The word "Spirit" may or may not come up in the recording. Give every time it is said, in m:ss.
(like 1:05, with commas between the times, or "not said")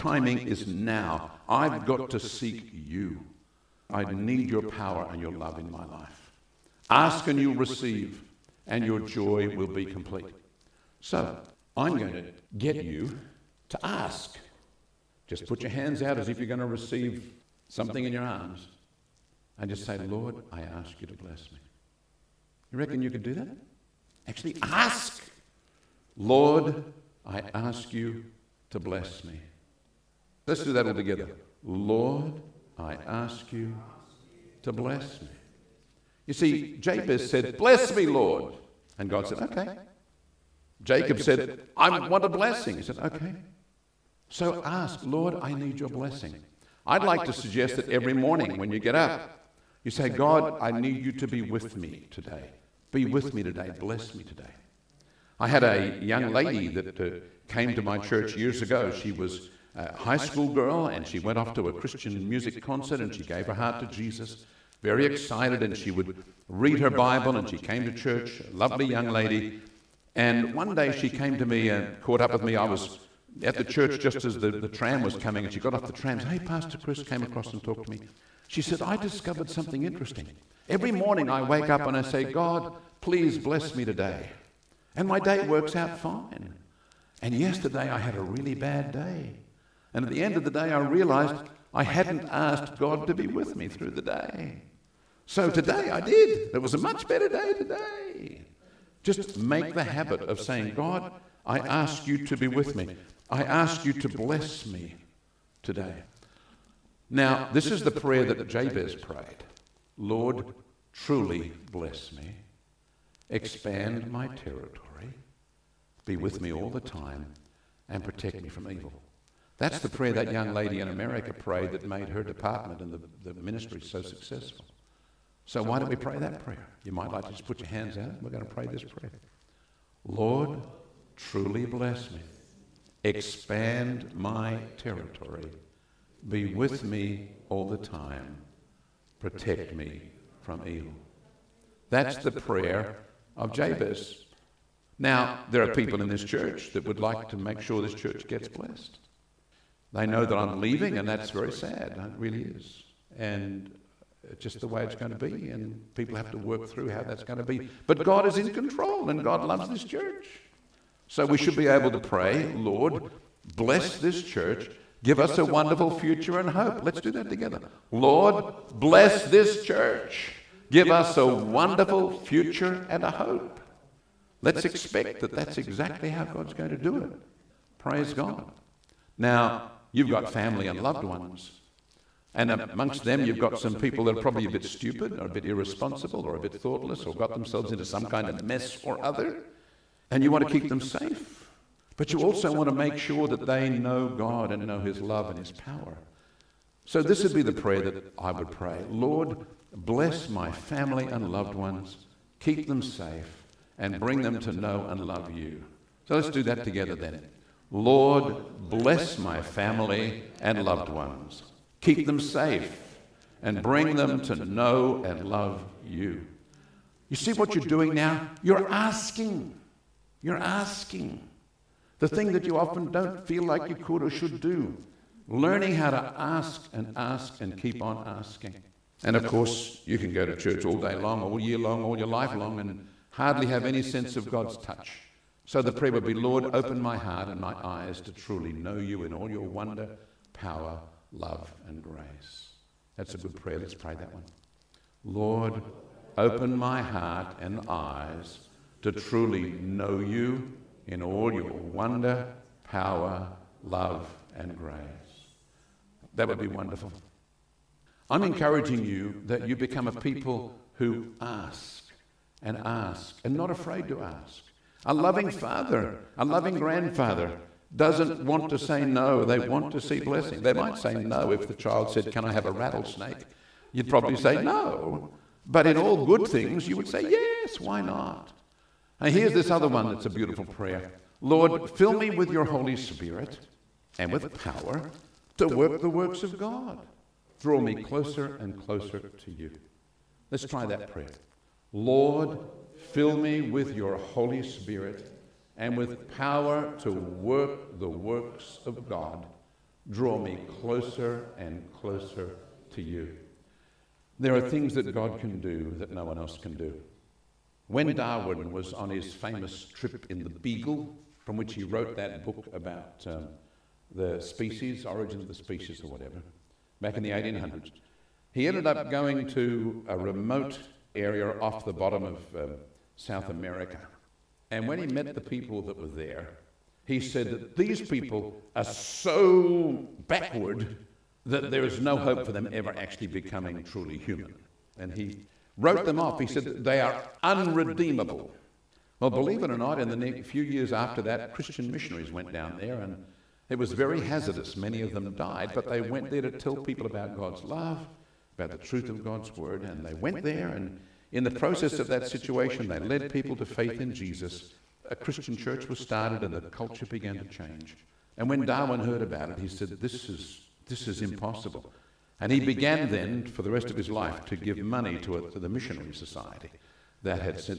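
4:42, 4:54.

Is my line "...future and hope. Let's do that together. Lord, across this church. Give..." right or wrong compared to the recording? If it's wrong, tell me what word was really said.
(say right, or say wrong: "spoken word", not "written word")
wrong: "bless", not "across".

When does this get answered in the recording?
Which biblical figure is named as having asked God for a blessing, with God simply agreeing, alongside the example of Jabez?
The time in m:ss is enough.
0:40.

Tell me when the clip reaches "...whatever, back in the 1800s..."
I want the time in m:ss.
5:15.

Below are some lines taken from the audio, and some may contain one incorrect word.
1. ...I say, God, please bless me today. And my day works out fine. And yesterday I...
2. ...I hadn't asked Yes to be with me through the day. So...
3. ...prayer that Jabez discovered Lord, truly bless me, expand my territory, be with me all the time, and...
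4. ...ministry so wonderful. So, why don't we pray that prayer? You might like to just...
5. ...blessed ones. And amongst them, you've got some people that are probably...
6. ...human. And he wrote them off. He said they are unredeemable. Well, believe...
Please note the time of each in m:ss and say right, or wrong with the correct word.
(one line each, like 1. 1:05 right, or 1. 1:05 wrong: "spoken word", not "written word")
1. 1:21 right
2. 1:31 wrong: "God", not "Yes"
3. 1:47 wrong: "prayed", not "discovered"
4. 2:03 wrong: "successful", not "wonderful"
5. 3:00 wrong: "loved", not "blessed"
6. 5:33 right.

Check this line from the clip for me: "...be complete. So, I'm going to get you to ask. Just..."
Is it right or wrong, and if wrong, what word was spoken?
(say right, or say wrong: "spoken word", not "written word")
right.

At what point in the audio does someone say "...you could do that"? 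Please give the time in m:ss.
0:23.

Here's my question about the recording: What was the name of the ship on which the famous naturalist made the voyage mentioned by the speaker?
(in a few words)
The Beagle.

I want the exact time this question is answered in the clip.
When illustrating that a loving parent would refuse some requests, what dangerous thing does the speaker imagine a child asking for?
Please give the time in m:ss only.
4:32.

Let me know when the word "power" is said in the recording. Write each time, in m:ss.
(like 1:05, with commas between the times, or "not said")
0:04, 3:15, 4:00, 4:12, 4:44, 4:56.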